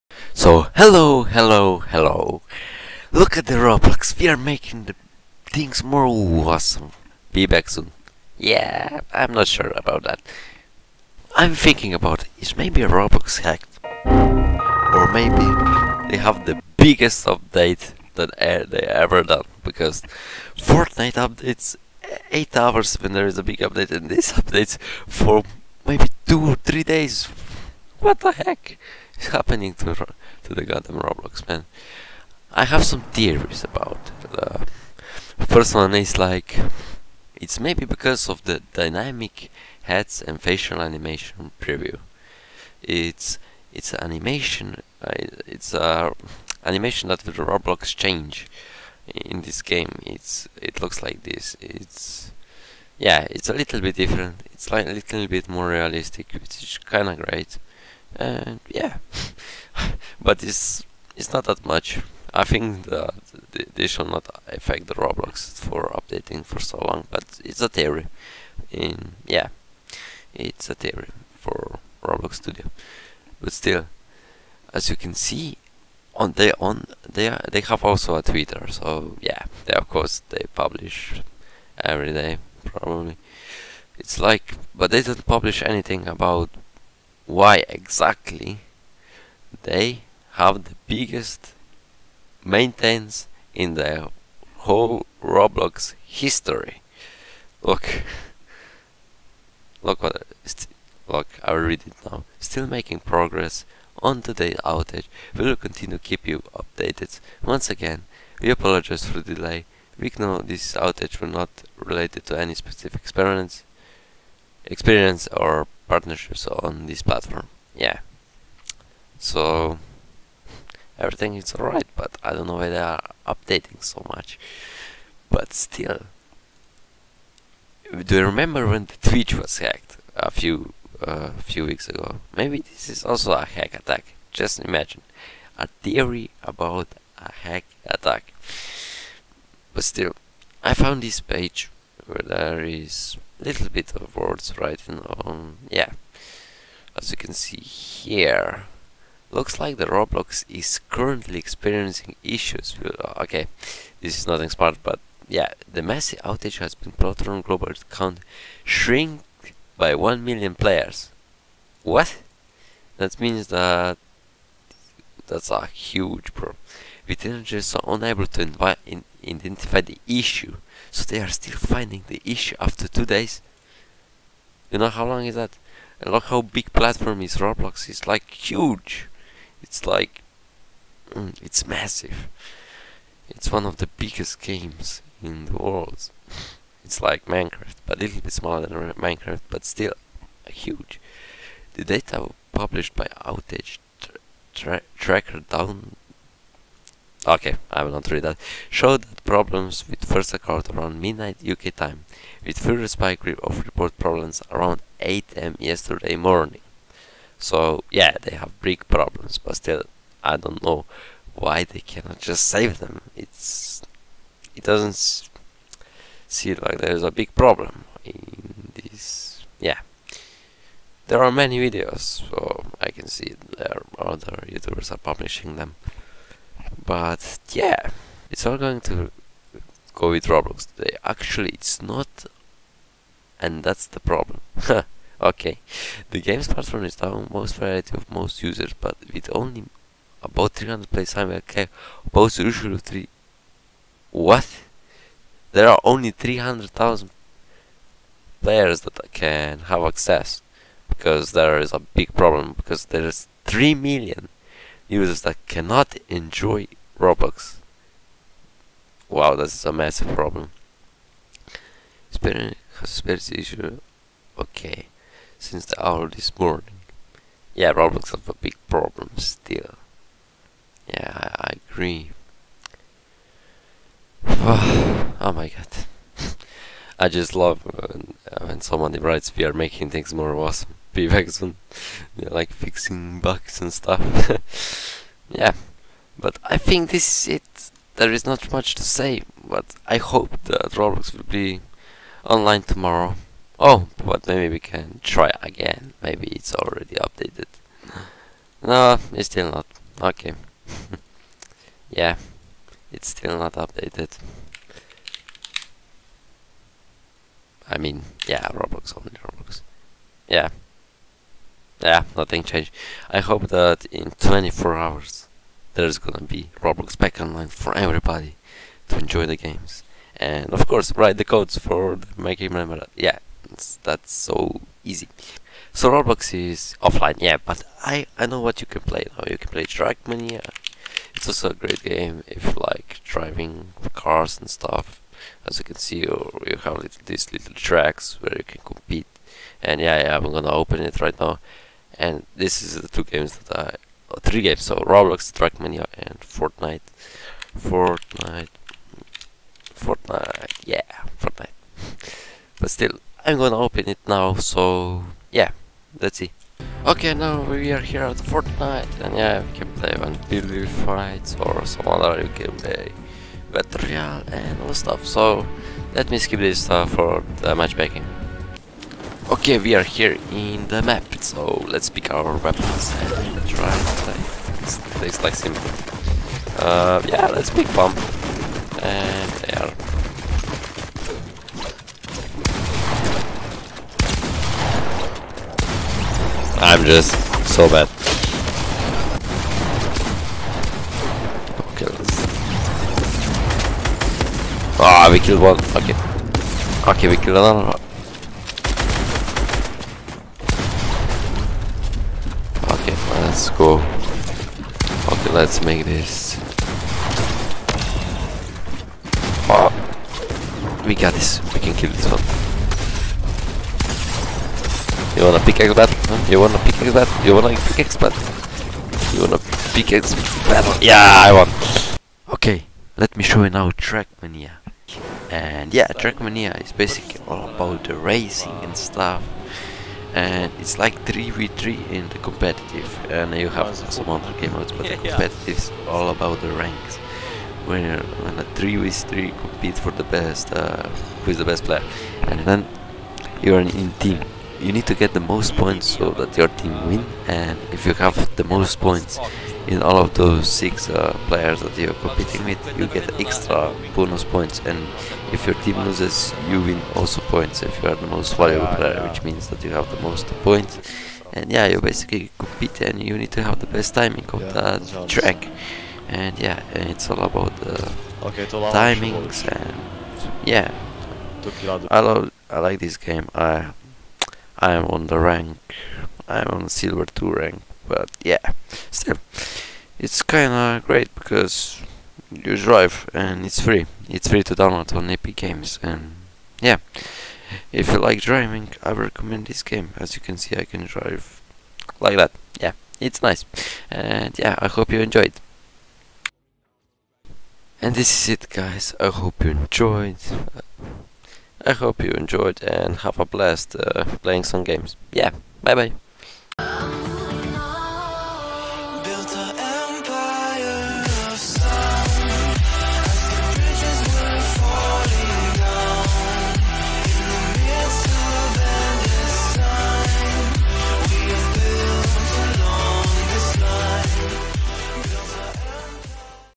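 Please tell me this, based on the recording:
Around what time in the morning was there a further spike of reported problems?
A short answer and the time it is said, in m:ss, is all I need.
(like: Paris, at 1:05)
8 am, at 3:24.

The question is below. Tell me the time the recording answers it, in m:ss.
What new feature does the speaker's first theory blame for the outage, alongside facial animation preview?
0:38.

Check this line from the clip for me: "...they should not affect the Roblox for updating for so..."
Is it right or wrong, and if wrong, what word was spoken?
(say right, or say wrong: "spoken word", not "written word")
right.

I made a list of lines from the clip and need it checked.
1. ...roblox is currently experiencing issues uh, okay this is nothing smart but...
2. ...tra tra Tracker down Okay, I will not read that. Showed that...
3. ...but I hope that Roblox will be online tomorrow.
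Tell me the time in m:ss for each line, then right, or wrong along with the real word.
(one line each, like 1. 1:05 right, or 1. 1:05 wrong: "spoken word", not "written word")
1. 2:29 right
2. 3:14 right
3. 4:49 right.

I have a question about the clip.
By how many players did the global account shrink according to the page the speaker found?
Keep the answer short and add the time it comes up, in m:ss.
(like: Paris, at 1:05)
1 million, at 2:39.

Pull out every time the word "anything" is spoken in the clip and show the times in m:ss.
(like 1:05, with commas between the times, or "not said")
1:25.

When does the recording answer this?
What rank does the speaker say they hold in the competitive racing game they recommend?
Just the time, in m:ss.
7:56.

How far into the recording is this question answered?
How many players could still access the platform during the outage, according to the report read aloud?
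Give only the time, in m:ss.
4:06.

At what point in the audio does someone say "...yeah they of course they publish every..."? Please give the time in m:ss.
1:19.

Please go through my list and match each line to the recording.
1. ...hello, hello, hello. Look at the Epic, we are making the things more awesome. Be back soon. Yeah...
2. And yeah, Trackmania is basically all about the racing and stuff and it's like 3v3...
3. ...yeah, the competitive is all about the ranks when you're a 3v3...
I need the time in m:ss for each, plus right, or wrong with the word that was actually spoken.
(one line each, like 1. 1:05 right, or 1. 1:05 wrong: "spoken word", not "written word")
1. 0:00 wrong: "Roblox", not "Epic"
2. 7:05 right
3. 7:14 right.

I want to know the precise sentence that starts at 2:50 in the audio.
So they are still finding the issue after two days.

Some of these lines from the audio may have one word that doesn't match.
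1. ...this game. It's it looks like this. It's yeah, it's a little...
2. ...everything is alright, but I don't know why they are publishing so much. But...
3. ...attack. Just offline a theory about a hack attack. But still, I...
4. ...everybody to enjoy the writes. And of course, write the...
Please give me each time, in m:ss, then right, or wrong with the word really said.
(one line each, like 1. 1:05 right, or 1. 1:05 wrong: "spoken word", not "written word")
1. 0:49 right
2. 2:00 wrong: "updating", not "publishing"
3. 2:13 wrong: "imagine", not "offline"
4. 5:17 wrong: "games", not "writes".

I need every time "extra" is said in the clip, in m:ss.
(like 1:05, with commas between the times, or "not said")
7:33.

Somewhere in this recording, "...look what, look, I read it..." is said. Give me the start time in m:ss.
1:39.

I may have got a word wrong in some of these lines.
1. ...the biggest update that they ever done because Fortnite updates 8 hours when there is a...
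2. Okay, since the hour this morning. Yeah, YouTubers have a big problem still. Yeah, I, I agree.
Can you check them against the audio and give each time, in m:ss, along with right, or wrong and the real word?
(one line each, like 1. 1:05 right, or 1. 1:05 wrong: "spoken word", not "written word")
1. 0:16 right
2. 4:24 wrong: "Roblox", not "YouTubers".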